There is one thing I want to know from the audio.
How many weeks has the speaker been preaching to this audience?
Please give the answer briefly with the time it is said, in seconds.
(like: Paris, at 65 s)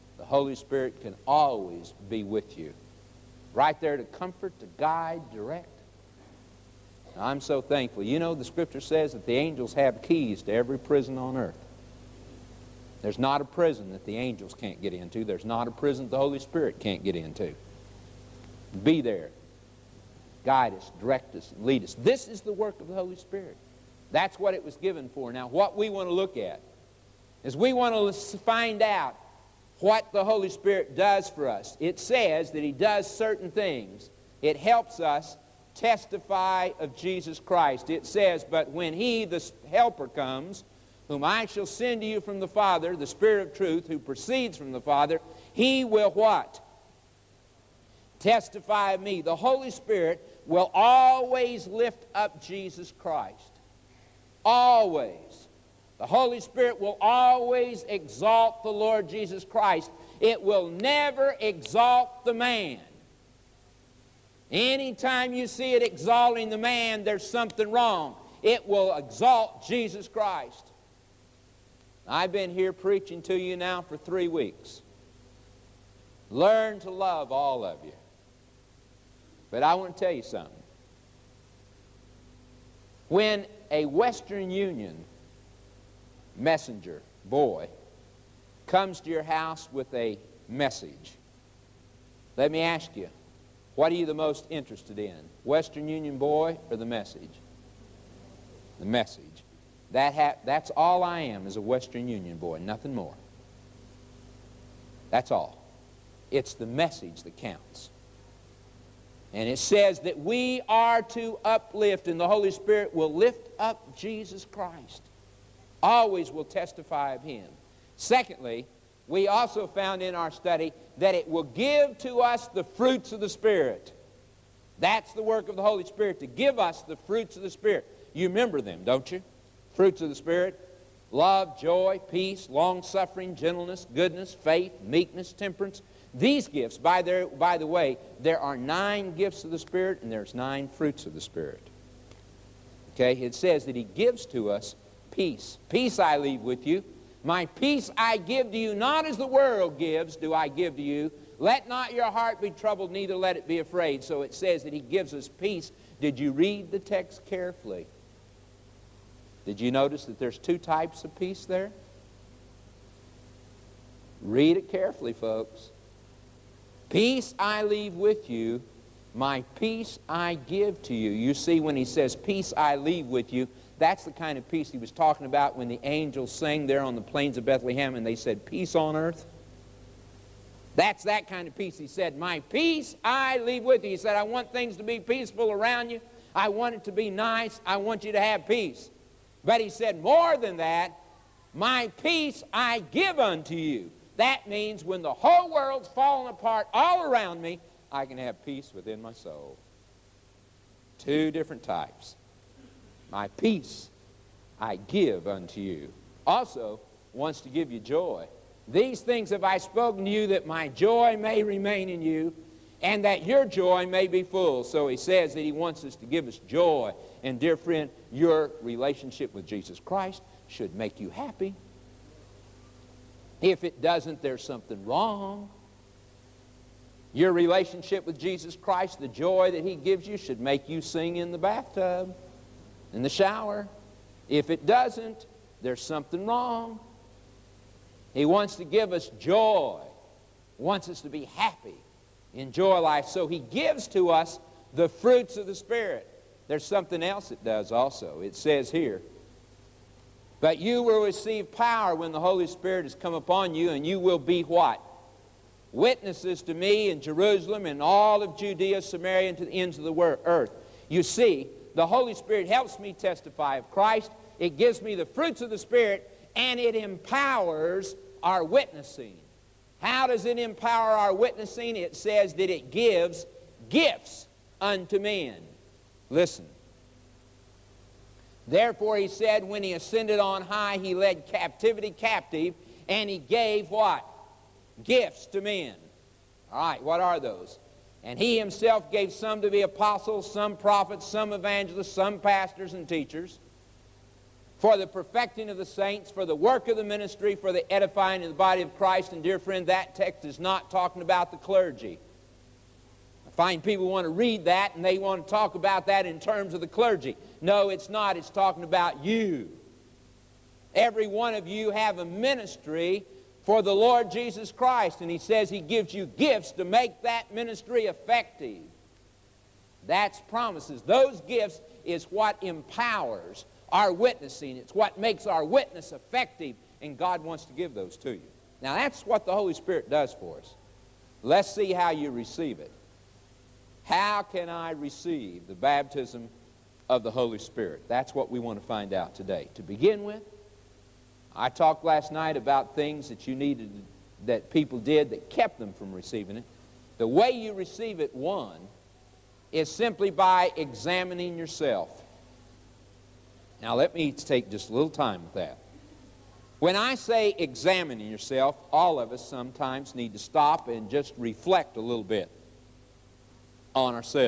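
3, at 73 s.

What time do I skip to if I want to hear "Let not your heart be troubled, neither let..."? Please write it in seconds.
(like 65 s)
151 s.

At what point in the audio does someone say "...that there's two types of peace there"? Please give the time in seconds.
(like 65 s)
160 s.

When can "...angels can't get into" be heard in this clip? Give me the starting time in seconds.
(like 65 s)
14 s.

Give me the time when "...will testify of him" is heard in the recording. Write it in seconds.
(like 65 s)
116 s.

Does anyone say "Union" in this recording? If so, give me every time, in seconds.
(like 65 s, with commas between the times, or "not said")
84 s, 95 s, 102 s.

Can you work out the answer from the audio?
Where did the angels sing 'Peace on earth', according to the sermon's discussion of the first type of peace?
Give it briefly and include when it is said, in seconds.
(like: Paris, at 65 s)
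plains of Bethlehem, at 177 s.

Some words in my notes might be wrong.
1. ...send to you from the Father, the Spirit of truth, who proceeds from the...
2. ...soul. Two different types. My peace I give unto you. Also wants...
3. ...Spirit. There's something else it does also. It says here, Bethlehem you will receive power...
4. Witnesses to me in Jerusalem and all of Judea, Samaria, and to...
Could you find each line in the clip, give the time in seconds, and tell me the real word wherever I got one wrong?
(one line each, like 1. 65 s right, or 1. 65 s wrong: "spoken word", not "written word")
1. 41 s right
2. 199 s right
3. 245 s wrong: "But", not "Bethlehem"
4. 255 s right.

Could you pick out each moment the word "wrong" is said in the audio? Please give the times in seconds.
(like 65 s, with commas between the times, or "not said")
67 s, 224 s, 236 s.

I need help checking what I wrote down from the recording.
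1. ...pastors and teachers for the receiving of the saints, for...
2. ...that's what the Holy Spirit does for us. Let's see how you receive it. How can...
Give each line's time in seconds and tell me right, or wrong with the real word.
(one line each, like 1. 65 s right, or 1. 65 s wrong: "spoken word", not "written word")
1. 292 s wrong: "perfecting", not "receiving"
2. 328 s right.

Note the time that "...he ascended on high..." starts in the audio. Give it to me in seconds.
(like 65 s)
279 s.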